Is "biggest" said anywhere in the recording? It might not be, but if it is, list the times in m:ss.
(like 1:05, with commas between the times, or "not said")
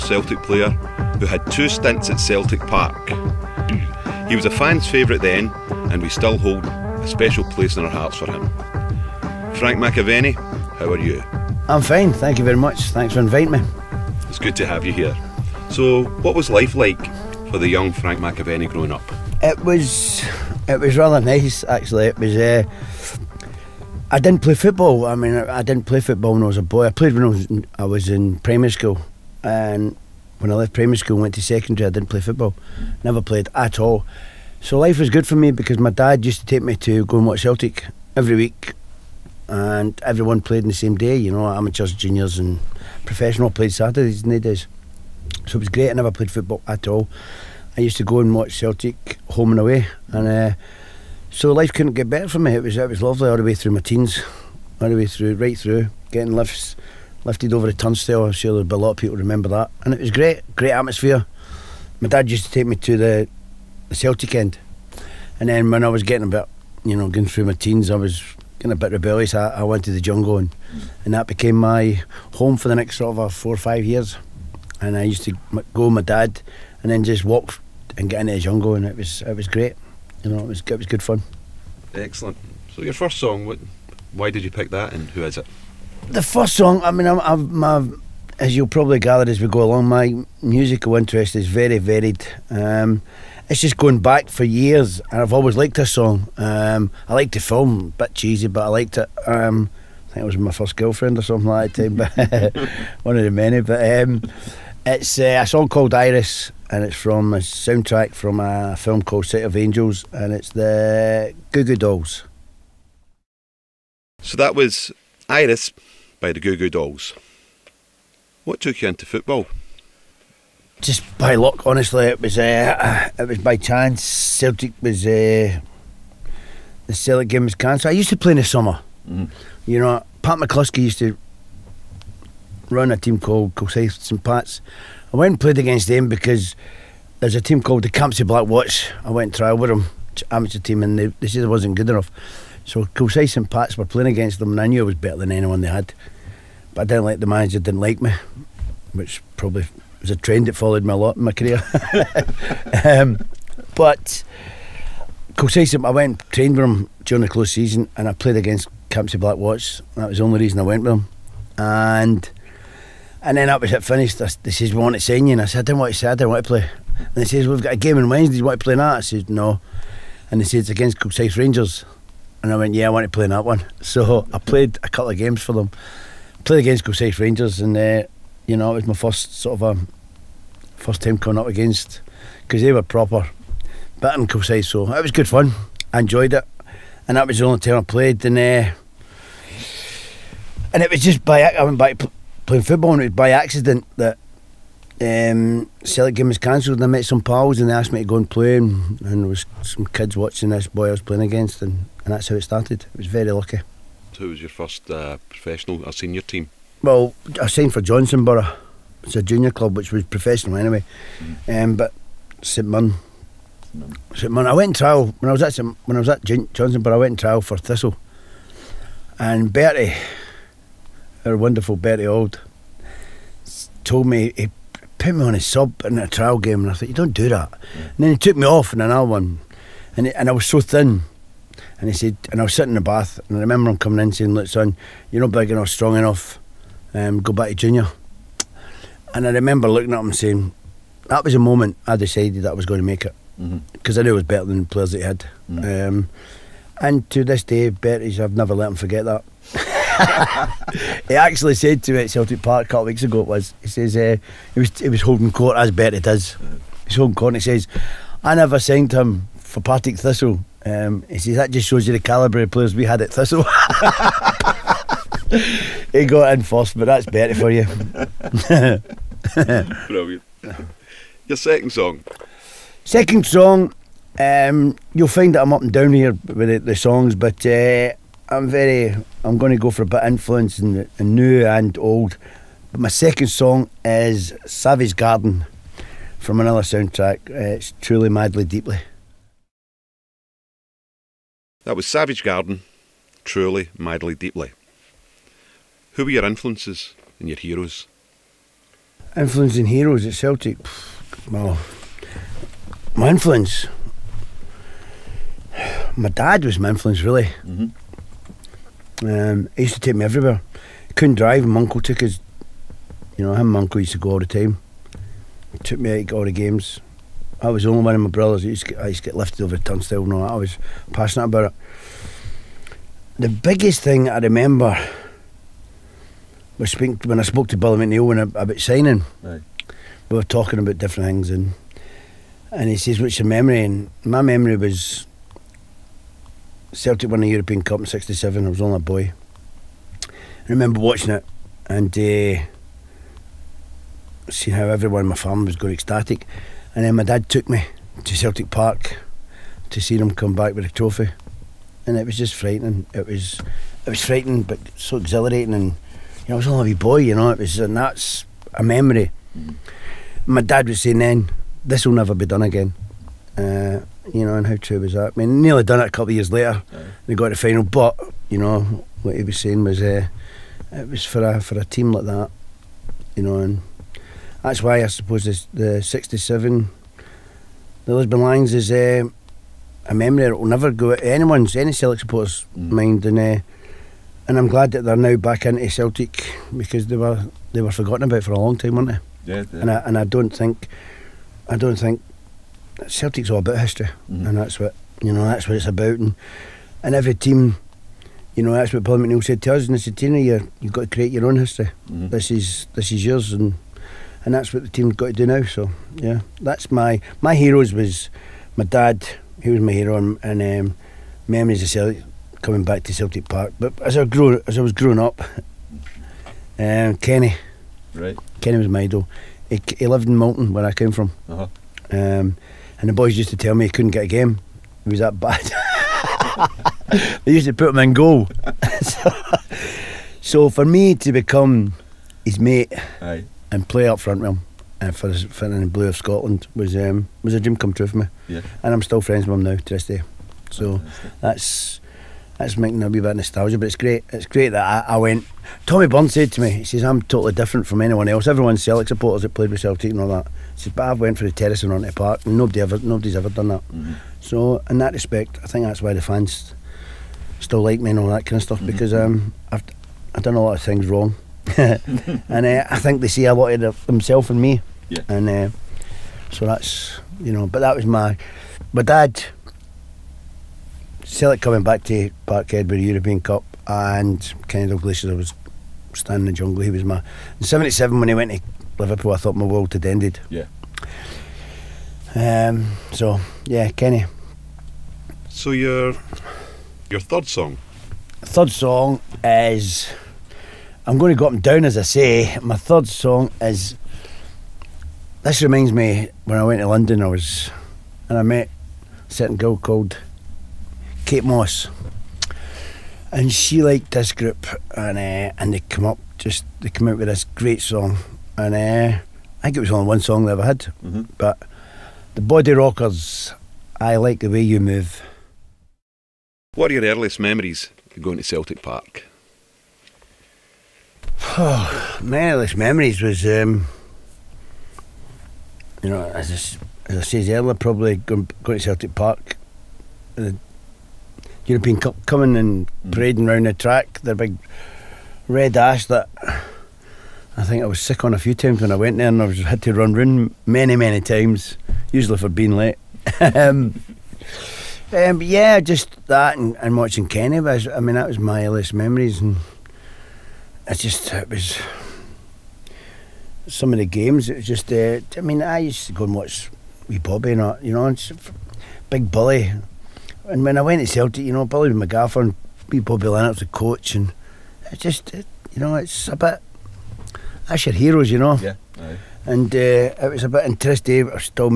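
5:23.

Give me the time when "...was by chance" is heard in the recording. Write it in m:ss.
2:03.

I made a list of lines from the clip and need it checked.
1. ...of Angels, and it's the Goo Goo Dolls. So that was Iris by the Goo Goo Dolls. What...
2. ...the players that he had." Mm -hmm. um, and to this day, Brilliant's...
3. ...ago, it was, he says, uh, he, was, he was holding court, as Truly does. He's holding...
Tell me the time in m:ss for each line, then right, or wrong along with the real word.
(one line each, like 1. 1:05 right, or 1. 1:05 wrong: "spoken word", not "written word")
1. 1:49 right
2. 4:04 wrong: "Bertie", not "Brilliant"
3. 4:13 wrong: "Bertie", not "Truly".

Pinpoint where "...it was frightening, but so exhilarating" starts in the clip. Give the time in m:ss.
5:53.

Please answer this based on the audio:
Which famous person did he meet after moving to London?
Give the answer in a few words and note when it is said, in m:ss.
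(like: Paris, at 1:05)
Kate Moss, at 8:21.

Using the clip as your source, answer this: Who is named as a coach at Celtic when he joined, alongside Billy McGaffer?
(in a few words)
Bobby Lennox.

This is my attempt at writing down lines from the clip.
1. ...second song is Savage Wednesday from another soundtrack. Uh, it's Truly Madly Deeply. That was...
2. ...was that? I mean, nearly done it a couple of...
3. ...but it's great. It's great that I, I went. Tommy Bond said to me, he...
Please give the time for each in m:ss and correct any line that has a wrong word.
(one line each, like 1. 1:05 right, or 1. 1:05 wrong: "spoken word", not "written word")
1. 4:42 wrong: "Garden", not "Wednesday"
2. 6:04 right
3. 7:23 right.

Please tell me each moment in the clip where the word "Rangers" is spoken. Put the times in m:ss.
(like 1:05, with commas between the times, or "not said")
2:51, 2:57.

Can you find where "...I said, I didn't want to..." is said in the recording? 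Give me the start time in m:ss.
2:45.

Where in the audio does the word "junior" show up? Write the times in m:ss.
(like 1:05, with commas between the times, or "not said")
0:41, 3:29, 3:57.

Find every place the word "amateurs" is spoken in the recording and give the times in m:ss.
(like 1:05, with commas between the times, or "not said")
0:41, 2:20.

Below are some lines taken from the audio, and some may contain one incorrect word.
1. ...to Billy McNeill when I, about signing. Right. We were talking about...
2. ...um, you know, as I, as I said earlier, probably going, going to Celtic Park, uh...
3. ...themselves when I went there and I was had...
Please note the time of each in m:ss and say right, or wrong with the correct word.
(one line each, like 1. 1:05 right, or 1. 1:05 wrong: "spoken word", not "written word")
1. 5:27 right
2. 8:43 right
3. 8:58 wrong: "times", not "themselves".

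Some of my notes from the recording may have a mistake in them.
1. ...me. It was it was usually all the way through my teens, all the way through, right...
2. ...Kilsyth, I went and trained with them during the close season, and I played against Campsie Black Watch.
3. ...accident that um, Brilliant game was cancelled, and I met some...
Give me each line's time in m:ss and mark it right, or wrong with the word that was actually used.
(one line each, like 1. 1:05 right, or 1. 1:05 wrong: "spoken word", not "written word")
1. 0:52 wrong: "lovely", not "usually"
2. 2:35 right
3. 3:13 wrong: "Celtic", not "Brilliant".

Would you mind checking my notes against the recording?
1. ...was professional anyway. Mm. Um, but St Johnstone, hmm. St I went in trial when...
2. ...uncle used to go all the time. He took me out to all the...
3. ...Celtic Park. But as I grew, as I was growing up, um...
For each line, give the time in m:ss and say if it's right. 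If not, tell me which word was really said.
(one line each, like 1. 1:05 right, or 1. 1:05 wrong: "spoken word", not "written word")
1. 3:29 wrong: "Mirren", not "Johnstone"
2. 5:13 right
3. 6:52 right.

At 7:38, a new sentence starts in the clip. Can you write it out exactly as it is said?
because um, I've, I've done a lot of things wrong.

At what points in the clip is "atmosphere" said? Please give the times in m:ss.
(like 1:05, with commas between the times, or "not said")
1:00.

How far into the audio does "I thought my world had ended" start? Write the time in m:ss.
7:59.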